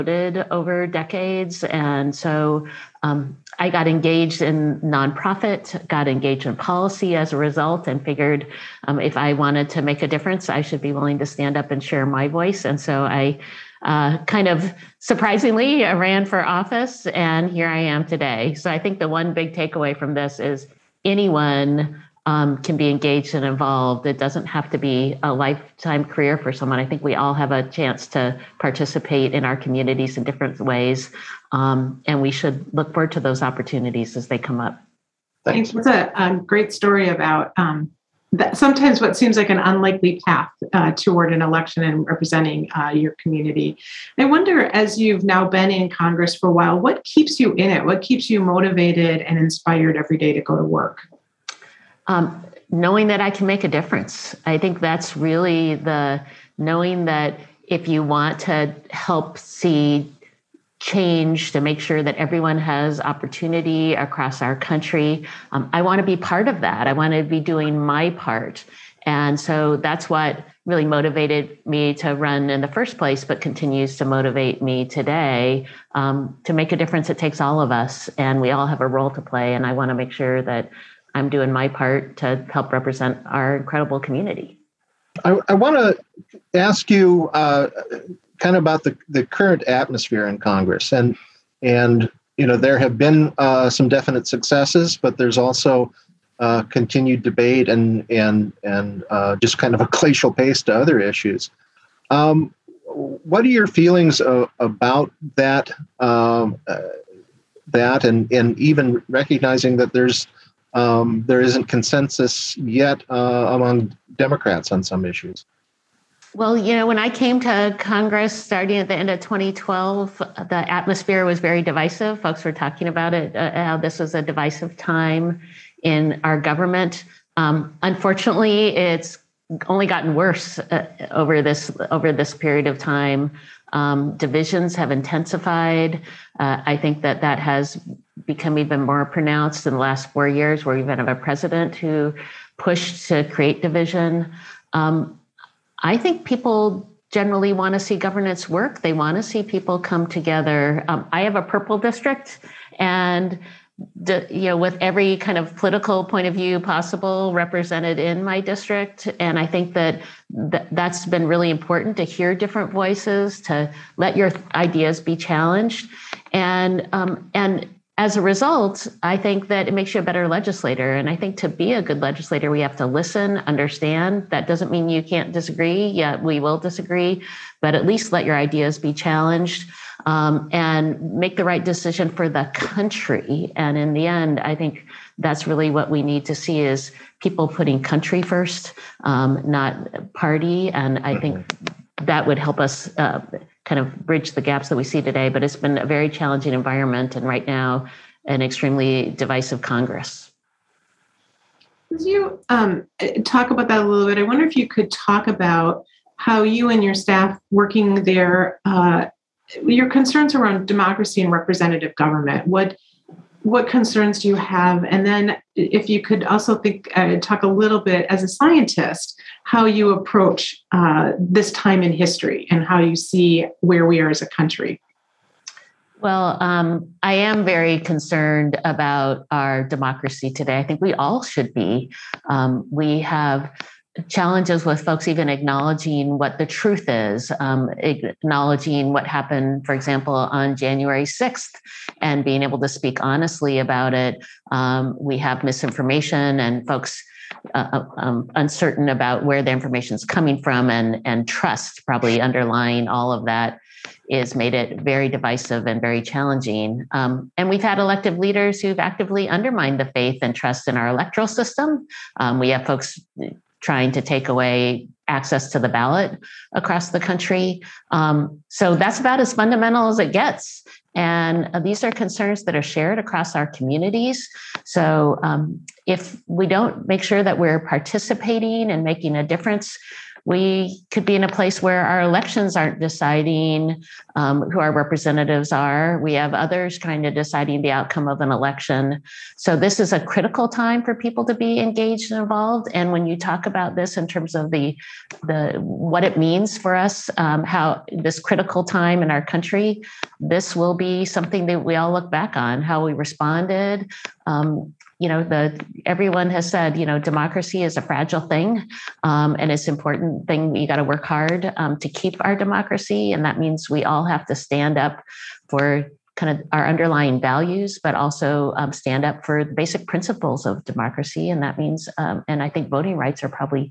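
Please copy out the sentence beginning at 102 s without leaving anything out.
Um, what are your feelings about that?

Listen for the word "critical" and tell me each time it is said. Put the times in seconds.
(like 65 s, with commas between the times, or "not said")
290 s, 298 s.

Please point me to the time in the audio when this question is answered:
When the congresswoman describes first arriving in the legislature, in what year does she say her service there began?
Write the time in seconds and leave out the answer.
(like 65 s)
119 s.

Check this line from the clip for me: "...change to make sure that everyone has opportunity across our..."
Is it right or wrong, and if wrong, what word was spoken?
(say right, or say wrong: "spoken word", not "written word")
right.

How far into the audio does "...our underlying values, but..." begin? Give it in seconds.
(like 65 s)
316 s.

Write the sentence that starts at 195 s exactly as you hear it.
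But it's been a very challenging environment, and right now, an extremely divisive Congress.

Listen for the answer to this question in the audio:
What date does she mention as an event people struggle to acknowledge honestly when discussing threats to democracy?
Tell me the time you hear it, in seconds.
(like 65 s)
240 s.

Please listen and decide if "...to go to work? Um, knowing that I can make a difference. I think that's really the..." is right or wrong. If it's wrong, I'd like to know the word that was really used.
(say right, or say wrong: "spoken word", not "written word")
right.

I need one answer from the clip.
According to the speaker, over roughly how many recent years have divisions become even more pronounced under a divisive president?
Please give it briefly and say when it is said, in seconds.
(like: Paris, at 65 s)
4 years, at 140 s.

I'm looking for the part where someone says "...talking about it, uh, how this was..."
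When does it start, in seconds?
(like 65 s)
122 s.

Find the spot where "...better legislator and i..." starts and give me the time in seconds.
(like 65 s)
170 s.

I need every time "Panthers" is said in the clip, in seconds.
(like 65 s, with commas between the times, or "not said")
not said.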